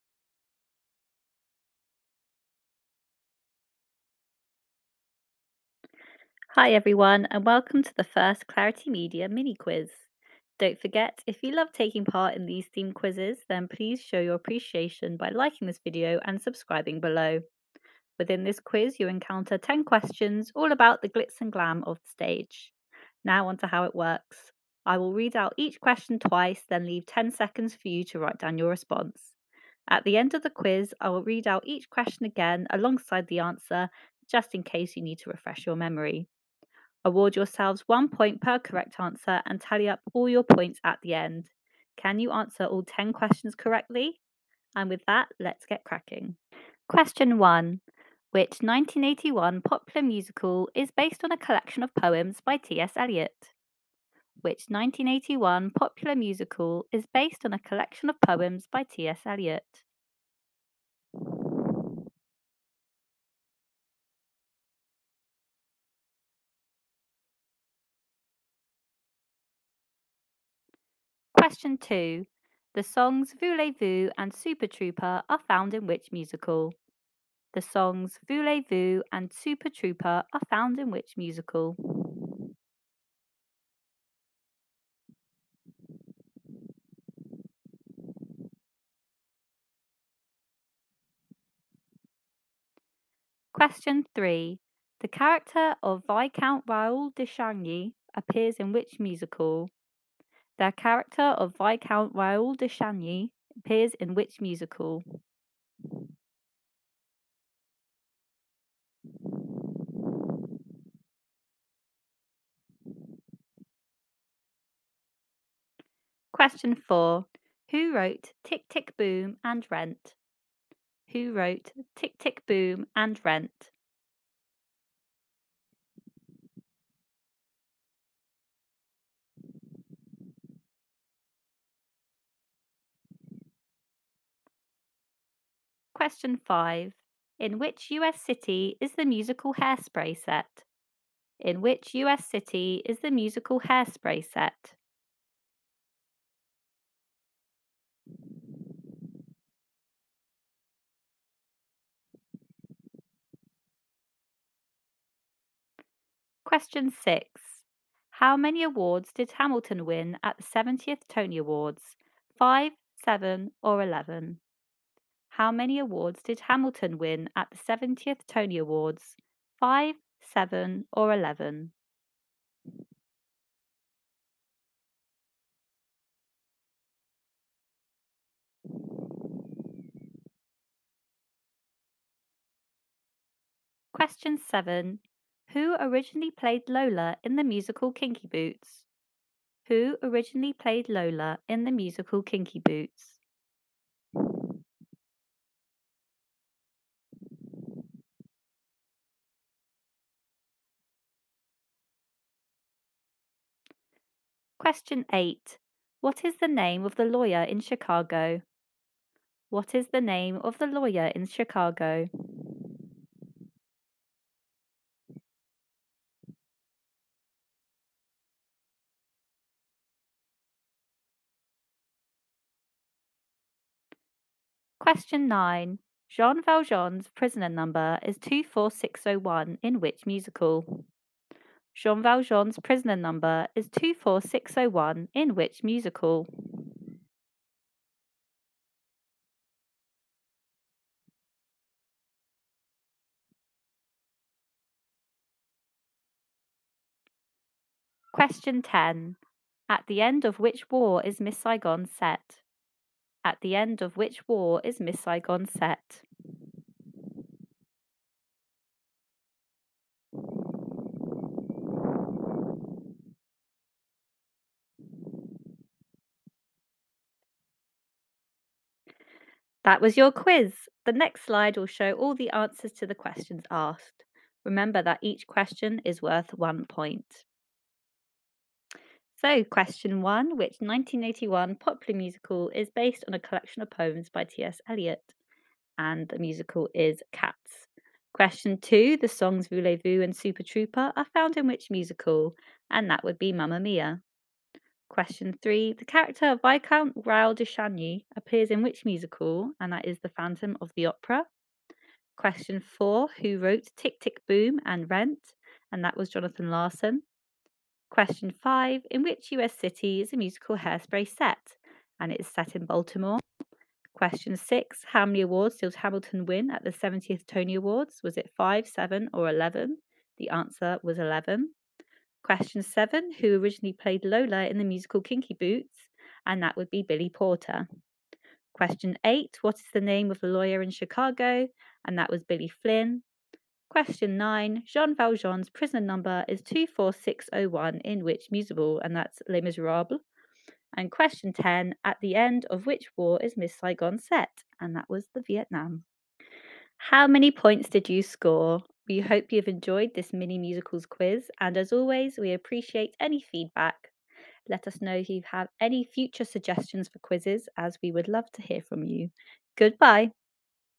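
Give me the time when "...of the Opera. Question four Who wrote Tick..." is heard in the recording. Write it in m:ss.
5:00.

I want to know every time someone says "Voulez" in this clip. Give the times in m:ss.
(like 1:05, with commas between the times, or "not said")
1:13, 1:18, 4:49.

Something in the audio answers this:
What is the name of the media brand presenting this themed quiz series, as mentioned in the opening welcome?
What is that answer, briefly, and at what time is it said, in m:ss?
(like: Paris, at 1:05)
Clarity Media, at 0:08.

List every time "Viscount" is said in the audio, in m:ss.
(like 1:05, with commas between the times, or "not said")
1:36, 1:41, 4:56.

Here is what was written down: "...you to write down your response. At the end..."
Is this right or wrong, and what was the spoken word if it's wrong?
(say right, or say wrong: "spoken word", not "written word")
right.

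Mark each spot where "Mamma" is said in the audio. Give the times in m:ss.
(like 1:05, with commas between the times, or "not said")
4:53.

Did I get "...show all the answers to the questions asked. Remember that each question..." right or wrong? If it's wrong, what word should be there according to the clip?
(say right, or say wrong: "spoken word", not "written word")
right.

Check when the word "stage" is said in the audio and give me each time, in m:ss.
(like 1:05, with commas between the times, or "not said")
0:22.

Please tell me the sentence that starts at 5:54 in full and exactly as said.
Let us know if you have any future suggestions for quizzes, as we would love to hear from you.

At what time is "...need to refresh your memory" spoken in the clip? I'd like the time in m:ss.
0:35.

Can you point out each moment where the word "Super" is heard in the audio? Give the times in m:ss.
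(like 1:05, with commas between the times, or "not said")
1:14, 1:19, 4:50.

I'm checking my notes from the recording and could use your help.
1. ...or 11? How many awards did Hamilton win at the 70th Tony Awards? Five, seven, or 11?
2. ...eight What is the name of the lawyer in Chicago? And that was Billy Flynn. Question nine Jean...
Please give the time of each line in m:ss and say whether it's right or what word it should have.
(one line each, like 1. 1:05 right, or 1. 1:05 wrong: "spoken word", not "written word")
1. 2:43 right
2. 5:29 right.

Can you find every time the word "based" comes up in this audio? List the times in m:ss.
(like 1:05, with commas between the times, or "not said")
0:50, 0:57, 4:42.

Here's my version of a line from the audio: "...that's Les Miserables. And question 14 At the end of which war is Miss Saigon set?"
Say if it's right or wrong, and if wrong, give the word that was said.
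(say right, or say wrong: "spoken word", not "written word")
wrong: "10", not "14".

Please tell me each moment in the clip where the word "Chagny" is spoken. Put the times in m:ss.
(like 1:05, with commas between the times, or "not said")
1:37, 1:42, 4:57.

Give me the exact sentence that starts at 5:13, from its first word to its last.
Question six How many awards did Hamilton win at the 70th Tony Awards?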